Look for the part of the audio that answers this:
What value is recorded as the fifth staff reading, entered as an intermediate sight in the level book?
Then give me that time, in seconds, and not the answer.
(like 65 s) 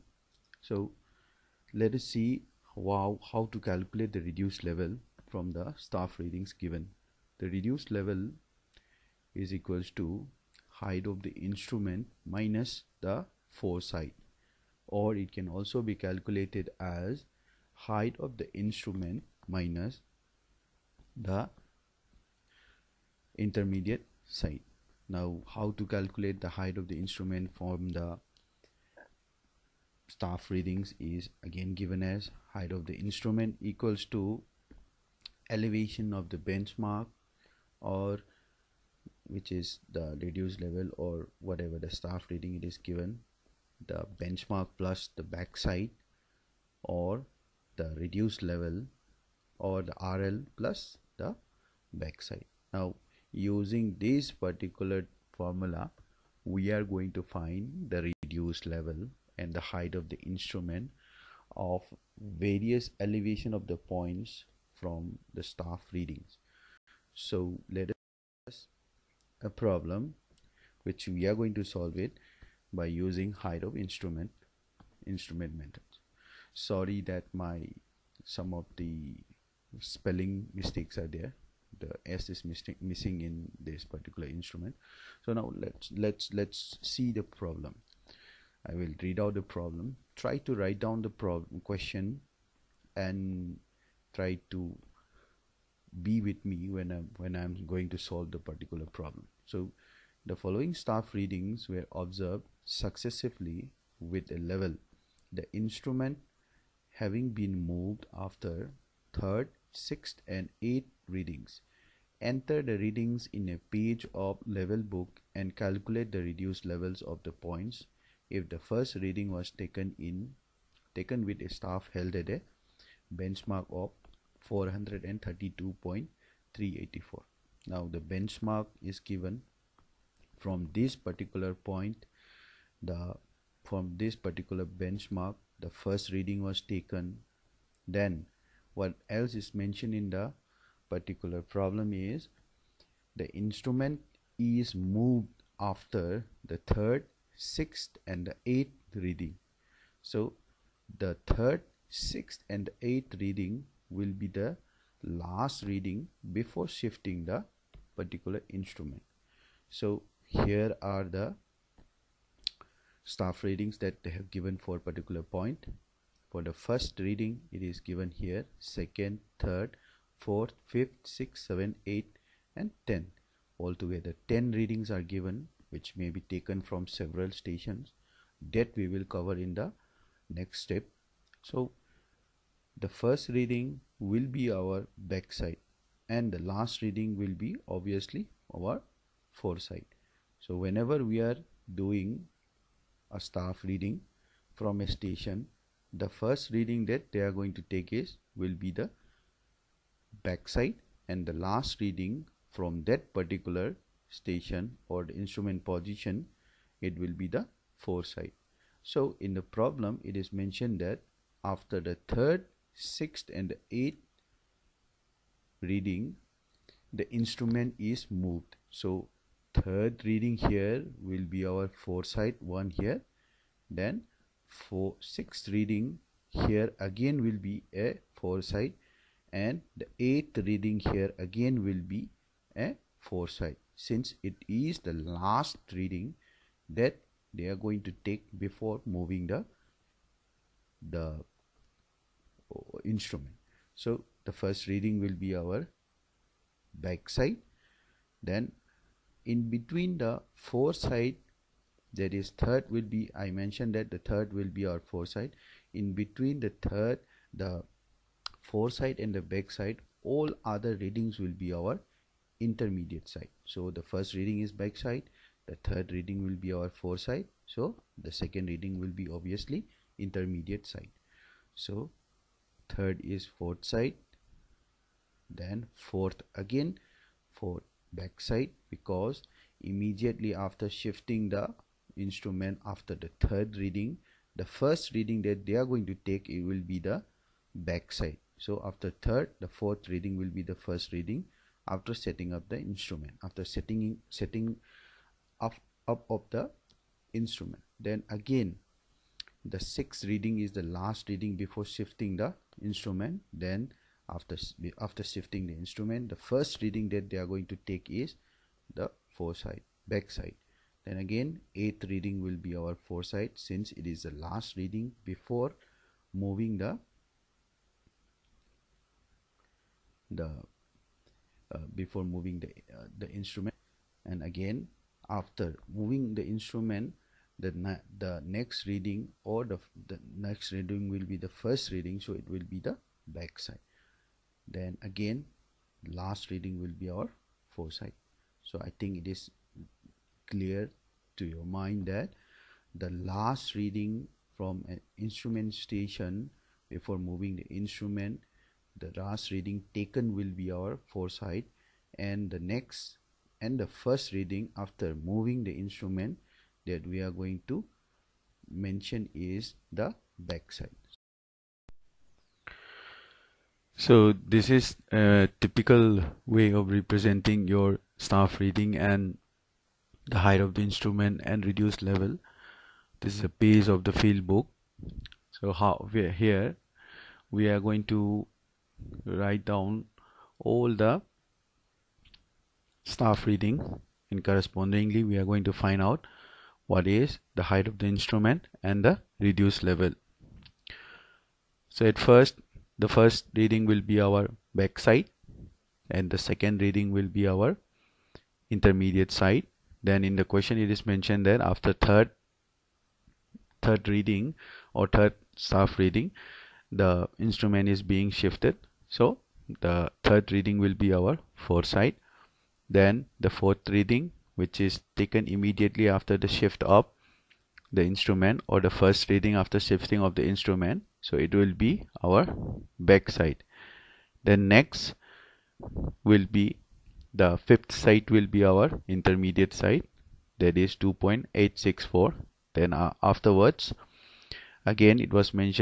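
430 s.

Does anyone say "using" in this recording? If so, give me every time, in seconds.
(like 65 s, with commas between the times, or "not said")
53 s, 72 s.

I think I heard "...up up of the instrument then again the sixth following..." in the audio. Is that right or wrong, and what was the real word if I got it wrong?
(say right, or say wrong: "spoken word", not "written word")
wrong: "reading", not "following".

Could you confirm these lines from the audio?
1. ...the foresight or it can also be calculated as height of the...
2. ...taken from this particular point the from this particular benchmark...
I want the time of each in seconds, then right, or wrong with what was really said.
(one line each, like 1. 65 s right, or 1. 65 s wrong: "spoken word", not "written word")
1. 13 s right
2. 128 s wrong: "given", not "taken".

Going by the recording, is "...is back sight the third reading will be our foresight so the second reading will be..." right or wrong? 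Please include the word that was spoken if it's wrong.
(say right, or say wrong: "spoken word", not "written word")
right.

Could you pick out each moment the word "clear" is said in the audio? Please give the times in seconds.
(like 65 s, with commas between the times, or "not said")
340 s.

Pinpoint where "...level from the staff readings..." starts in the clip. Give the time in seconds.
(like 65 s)
4 s.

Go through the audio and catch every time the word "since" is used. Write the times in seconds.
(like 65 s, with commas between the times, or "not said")
233 s, 313 s.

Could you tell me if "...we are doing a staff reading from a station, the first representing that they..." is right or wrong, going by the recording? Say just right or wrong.
wrong.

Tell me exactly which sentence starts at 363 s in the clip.
So this is a typical way of representing your staff reading and the height of the instrument and reduced level.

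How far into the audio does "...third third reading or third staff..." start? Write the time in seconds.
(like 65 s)
401 s.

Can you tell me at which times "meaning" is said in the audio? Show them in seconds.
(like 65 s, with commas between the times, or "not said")
not said.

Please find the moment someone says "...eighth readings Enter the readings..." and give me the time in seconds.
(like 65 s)
110 s.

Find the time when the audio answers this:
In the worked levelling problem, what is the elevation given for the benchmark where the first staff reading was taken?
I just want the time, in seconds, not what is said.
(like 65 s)
124 s.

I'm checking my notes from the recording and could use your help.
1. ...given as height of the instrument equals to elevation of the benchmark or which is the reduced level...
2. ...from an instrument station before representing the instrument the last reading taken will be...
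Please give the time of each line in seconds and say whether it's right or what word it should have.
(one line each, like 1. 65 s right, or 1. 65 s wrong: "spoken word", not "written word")
1. 31 s right
2. 344 s wrong: "moving", not "representing".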